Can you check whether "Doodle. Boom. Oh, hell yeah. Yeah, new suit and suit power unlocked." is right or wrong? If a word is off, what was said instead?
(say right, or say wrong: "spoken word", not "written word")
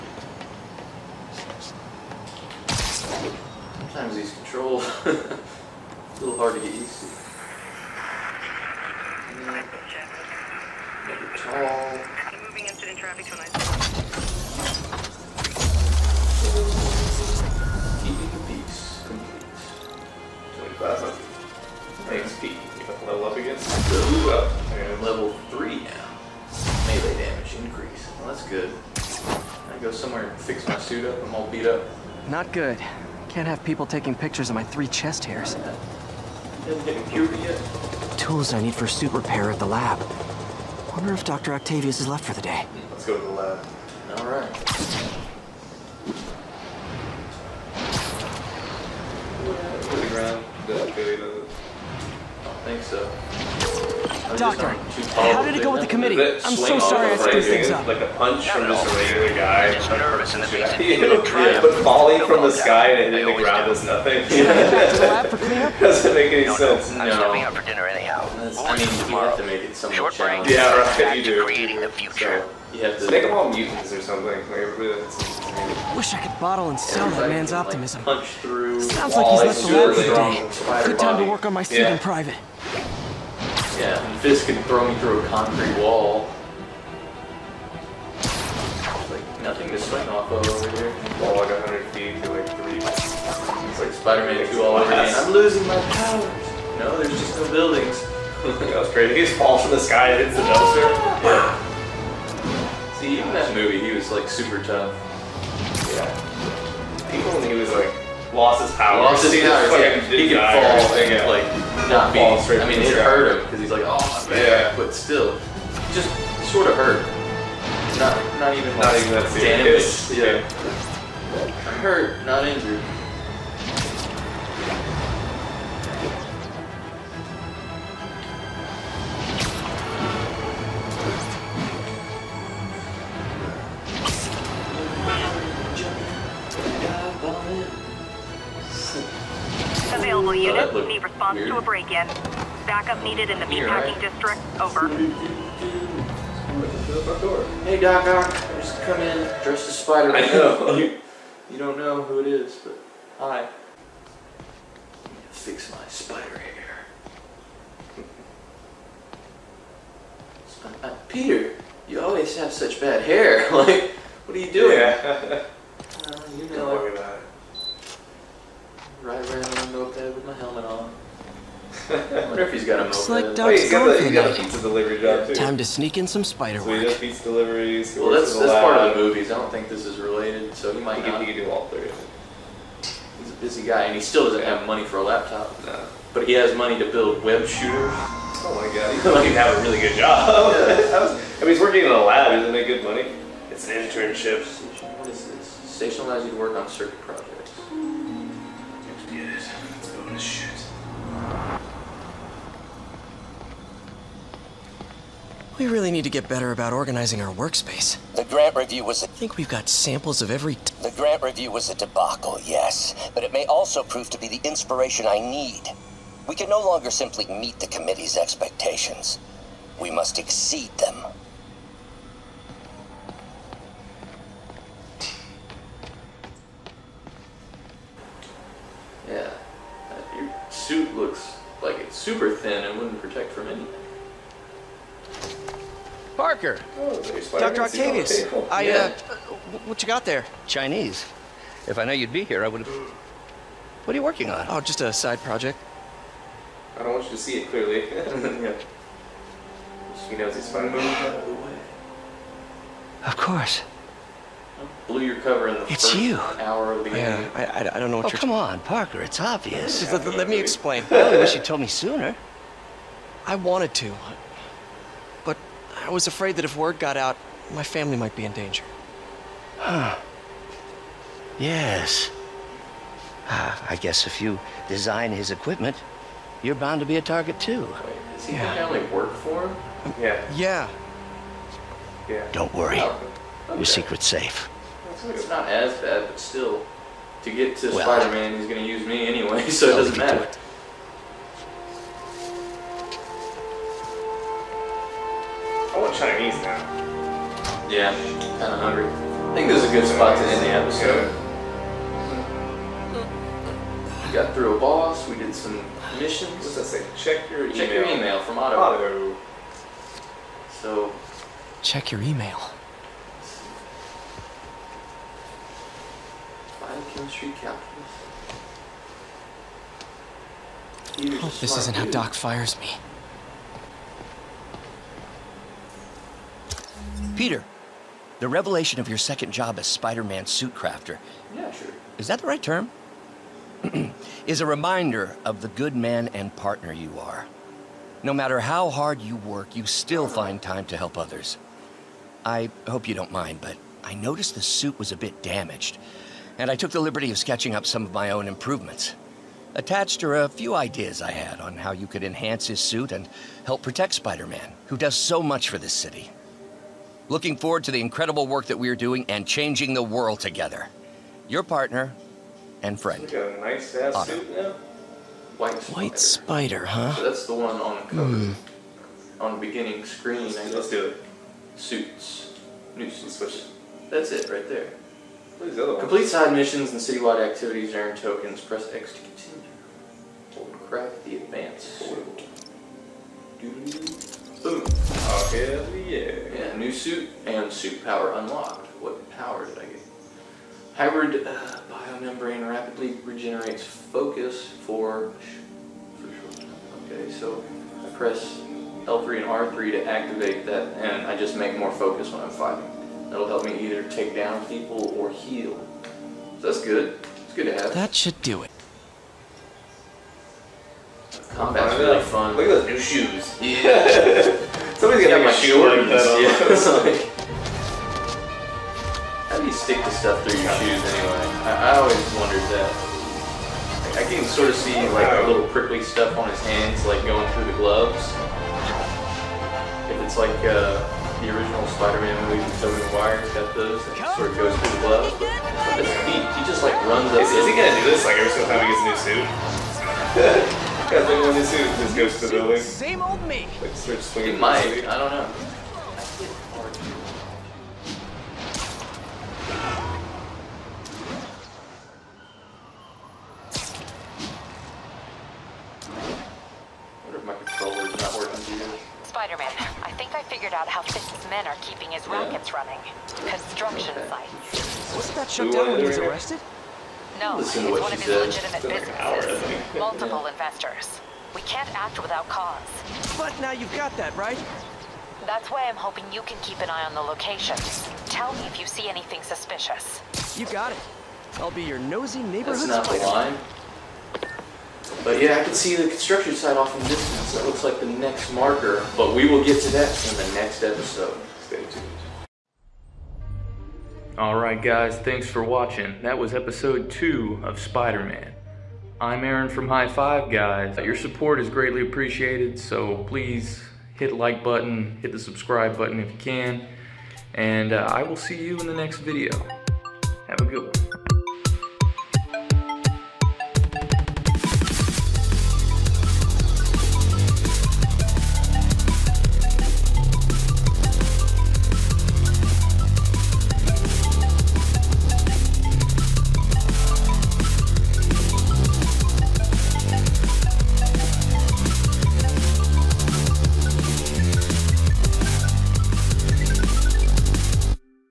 right.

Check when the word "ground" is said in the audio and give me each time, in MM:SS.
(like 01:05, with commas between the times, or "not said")
00:50, 01:03.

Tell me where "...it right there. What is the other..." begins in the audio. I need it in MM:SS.
06:14.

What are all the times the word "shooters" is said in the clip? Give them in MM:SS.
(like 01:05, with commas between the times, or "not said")
03:07.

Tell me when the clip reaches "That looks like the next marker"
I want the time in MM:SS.
08:07.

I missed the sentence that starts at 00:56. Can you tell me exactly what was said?
I'm so sorry I screwed things up.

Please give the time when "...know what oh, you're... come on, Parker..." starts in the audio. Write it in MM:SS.
04:17.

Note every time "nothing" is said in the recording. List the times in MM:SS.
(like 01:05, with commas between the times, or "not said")
01:03, 01:29.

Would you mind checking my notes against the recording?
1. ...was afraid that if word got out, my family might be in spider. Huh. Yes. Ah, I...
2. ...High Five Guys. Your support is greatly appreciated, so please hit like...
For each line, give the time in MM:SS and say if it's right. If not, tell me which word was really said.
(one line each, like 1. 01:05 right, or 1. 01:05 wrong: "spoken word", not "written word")
1. 04:25 wrong: "danger", not "spider"
2. 08:19 right.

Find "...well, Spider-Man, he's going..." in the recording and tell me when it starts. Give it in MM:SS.
04:47.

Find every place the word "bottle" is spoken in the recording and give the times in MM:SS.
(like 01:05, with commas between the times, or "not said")
01:16.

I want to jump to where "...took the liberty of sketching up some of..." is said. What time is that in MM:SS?
05:46.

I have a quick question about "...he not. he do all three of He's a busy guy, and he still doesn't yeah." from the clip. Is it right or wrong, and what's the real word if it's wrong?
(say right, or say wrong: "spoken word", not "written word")
right.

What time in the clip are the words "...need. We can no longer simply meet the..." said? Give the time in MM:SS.
03:35.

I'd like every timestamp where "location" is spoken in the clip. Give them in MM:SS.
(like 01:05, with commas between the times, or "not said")
07:57.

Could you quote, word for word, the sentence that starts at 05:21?
Hope this isn't how Doc fires me.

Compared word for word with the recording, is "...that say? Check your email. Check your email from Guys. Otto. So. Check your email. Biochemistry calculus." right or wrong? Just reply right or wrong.
wrong.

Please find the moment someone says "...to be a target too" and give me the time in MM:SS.
04:36.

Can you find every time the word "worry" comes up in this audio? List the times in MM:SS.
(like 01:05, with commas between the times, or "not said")
02:46, 04:42.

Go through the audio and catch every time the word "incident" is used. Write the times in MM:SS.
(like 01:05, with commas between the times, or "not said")
00:12.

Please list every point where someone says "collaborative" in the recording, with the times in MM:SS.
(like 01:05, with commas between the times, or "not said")
not said.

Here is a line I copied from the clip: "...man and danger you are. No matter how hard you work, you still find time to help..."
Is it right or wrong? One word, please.
wrong.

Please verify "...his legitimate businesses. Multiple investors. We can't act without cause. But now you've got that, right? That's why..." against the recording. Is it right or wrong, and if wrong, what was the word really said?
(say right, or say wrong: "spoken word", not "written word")
right.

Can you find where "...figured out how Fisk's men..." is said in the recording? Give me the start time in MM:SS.
07:40.